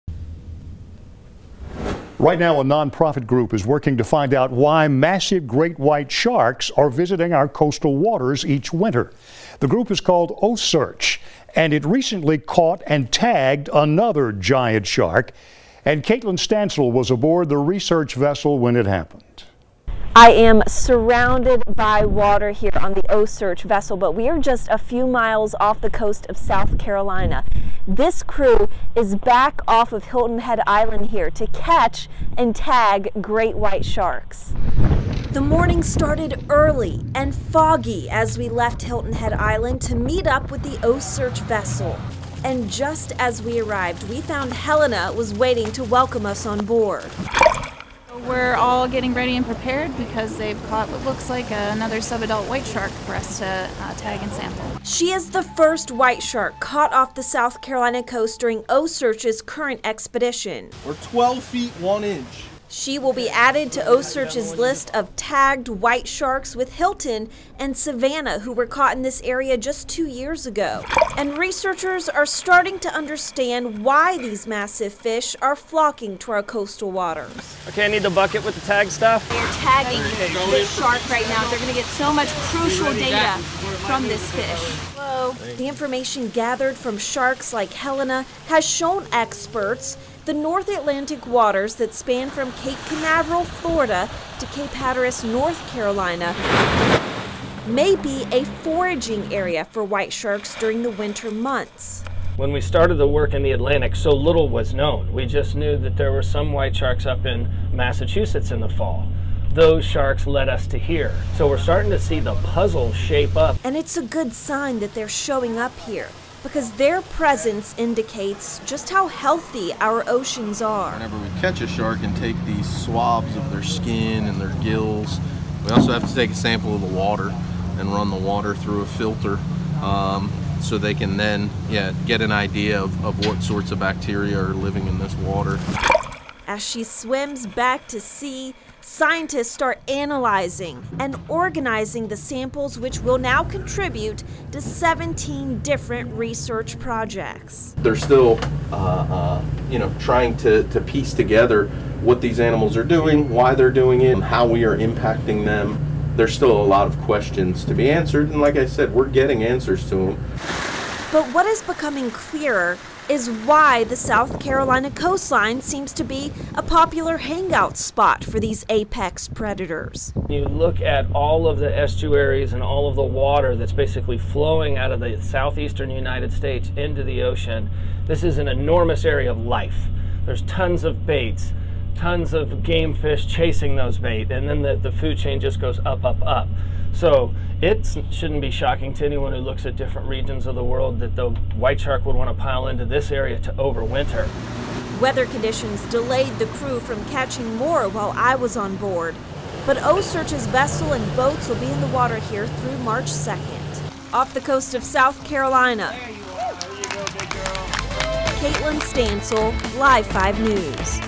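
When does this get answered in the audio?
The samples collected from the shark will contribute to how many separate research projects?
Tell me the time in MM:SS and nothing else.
02:24.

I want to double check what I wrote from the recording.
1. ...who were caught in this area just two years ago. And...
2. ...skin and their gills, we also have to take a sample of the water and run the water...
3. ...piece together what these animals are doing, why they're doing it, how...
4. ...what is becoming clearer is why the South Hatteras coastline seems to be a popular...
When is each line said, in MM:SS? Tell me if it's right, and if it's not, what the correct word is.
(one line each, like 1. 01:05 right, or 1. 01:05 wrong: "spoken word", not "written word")
1. 01:08 right
2. 02:03 right
3. 02:30 right
4. 02:41 wrong: "Carolina", not "Hatteras".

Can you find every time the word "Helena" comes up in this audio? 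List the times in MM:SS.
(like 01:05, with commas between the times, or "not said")
00:44, 01:27.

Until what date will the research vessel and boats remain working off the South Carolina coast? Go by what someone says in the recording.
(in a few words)
March 2nd.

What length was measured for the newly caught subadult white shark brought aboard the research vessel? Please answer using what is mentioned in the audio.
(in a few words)
12 feet 1 inch.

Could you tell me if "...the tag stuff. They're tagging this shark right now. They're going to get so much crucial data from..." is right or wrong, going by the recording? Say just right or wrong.
right.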